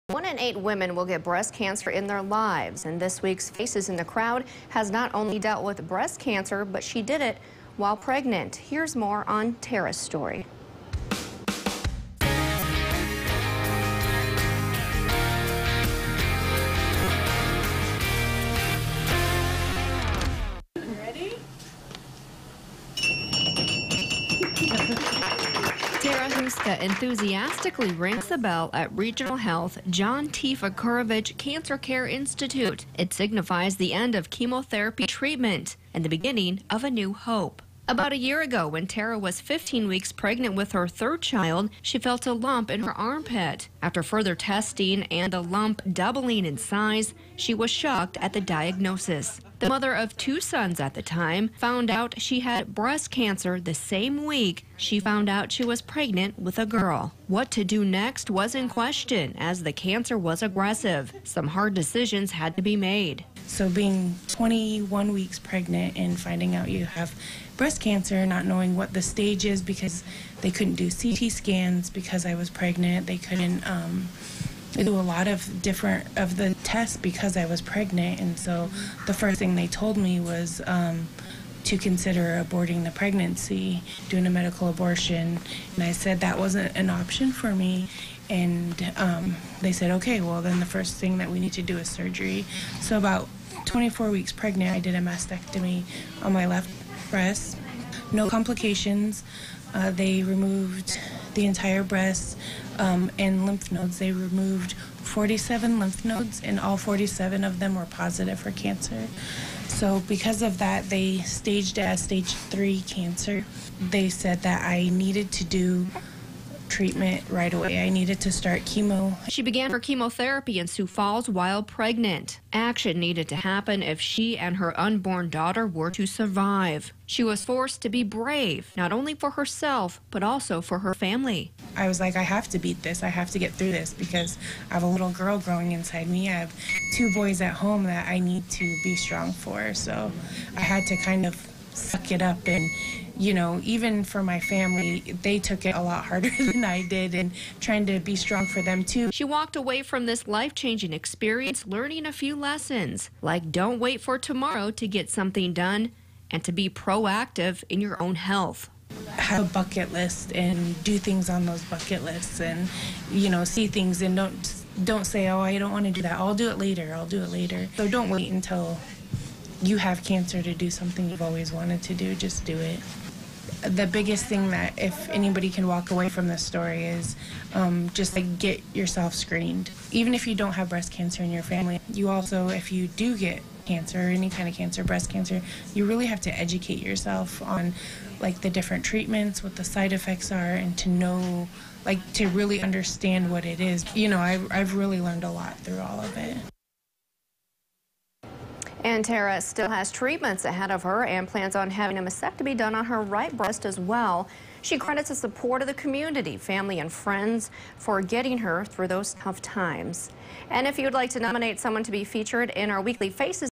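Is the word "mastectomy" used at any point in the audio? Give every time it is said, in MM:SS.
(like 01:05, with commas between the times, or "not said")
01:34, 03:22.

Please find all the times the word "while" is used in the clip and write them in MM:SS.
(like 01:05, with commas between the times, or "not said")
00:07, 02:01.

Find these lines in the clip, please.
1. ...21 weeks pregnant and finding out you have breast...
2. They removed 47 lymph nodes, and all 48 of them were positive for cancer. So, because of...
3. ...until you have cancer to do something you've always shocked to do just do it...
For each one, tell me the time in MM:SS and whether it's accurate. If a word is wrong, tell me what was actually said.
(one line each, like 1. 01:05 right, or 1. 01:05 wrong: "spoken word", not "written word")
1. 01:04 right
2. 01:43 wrong: "47", not "48"
3. 02:48 wrong: "wanted", not "shocked".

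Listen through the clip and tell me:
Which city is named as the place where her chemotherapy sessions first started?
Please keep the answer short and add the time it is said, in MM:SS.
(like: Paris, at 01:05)
Sioux Falls, at 02:00.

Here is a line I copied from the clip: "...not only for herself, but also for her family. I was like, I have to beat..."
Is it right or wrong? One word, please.
right.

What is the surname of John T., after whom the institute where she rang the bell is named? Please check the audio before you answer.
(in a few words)
Vucurevich.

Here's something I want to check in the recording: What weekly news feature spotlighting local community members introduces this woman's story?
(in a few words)
Faces in the Crowd.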